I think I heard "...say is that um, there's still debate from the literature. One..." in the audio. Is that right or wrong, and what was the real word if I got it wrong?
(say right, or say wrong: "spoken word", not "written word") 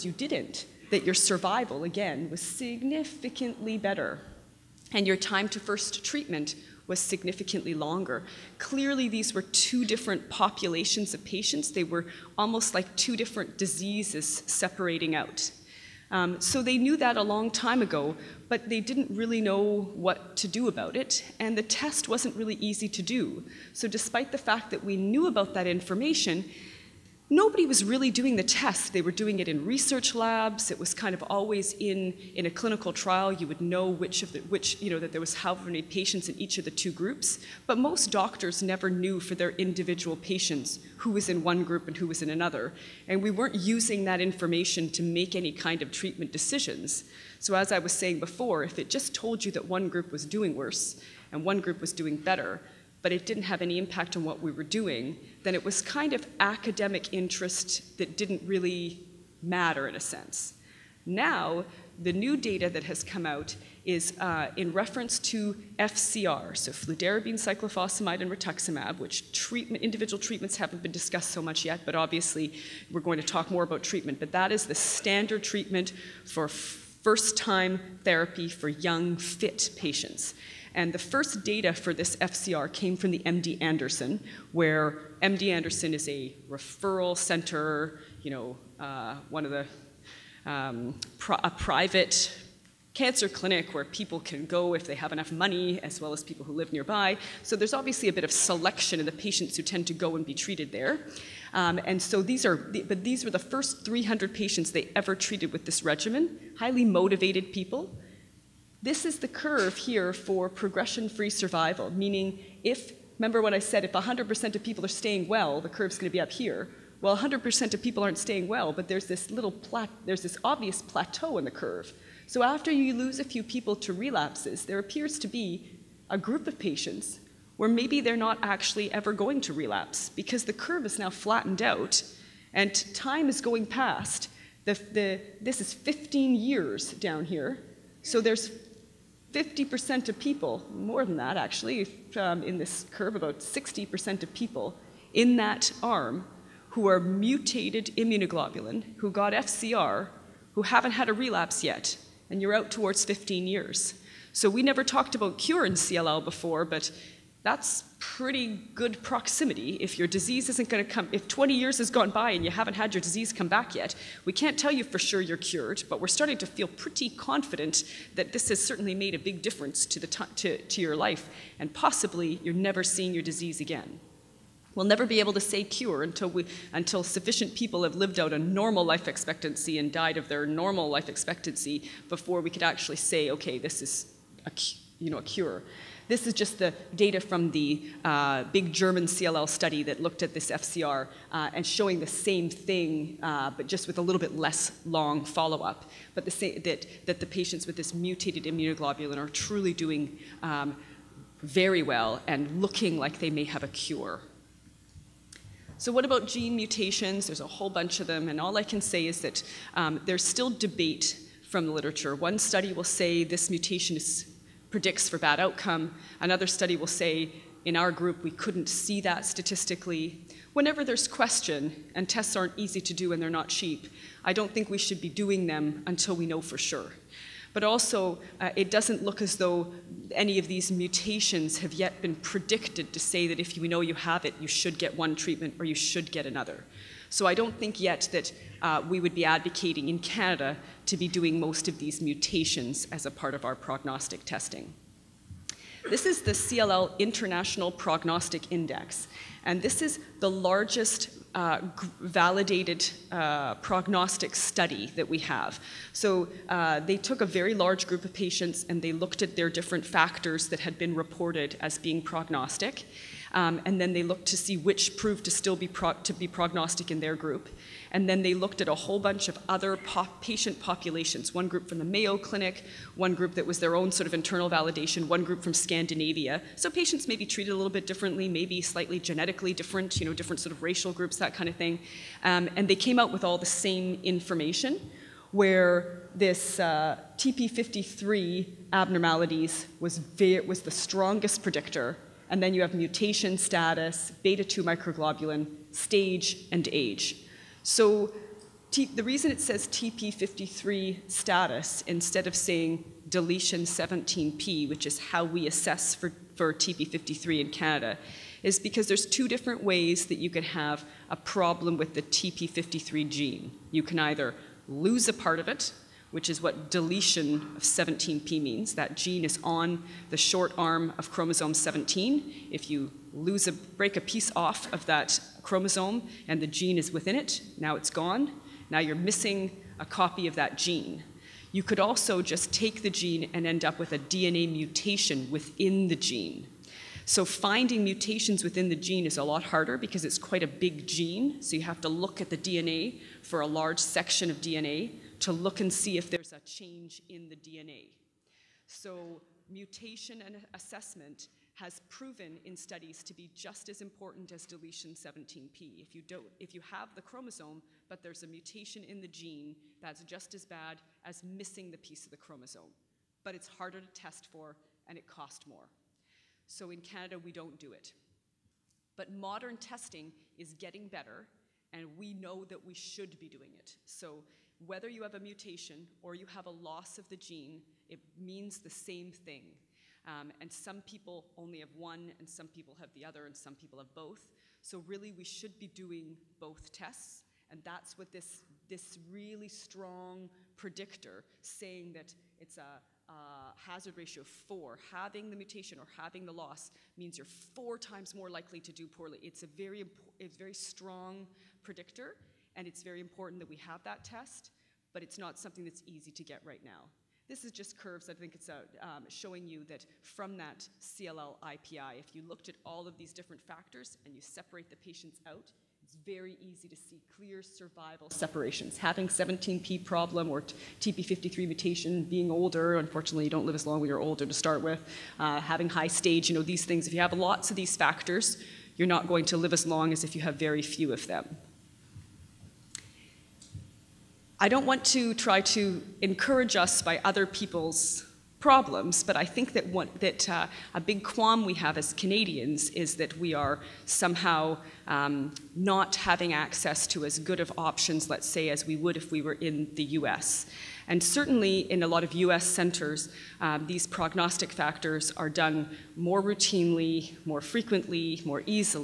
right.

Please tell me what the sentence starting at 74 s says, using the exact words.
But that is the standard treatment for first time therapy for young, fit patients.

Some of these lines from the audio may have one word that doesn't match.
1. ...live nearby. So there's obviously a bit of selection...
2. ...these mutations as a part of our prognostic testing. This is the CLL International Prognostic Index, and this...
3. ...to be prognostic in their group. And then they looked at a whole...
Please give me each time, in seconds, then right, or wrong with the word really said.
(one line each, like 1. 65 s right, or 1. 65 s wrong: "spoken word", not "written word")
1. 96 s right
2. 241 s right
3. 266 s right.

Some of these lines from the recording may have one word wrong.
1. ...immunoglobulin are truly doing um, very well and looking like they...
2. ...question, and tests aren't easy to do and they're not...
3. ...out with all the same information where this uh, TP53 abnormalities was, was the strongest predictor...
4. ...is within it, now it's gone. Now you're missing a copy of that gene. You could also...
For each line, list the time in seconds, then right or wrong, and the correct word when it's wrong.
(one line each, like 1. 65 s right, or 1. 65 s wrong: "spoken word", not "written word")
1. 198 s right
2. 221 s right
3. 282 s right
4. 326 s right.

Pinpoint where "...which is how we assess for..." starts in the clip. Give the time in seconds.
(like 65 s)
304 s.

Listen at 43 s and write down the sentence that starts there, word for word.
And we weren't using that information to make any kind of treatment decisions.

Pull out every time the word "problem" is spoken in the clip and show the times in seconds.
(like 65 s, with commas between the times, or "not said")
311 s, 419 s, 438 s.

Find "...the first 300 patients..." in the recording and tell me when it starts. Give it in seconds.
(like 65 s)
103 s.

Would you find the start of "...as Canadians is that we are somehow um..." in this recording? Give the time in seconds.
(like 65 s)
441 s.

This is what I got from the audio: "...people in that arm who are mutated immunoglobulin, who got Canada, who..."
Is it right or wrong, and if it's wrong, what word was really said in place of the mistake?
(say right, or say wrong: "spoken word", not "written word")
wrong: "FCR", not "Canada".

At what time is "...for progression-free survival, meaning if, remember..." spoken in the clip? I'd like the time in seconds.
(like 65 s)
110 s.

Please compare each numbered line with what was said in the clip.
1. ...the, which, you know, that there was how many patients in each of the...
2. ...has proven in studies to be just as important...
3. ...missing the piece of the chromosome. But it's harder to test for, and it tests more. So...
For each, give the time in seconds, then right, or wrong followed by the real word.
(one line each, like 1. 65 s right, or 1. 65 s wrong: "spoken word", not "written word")
1. 34 s right
2. 351 s right
3. 361 s wrong: "costs", not "tests".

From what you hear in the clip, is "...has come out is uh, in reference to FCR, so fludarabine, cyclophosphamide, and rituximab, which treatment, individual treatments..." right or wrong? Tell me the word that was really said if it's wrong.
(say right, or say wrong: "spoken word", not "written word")
right.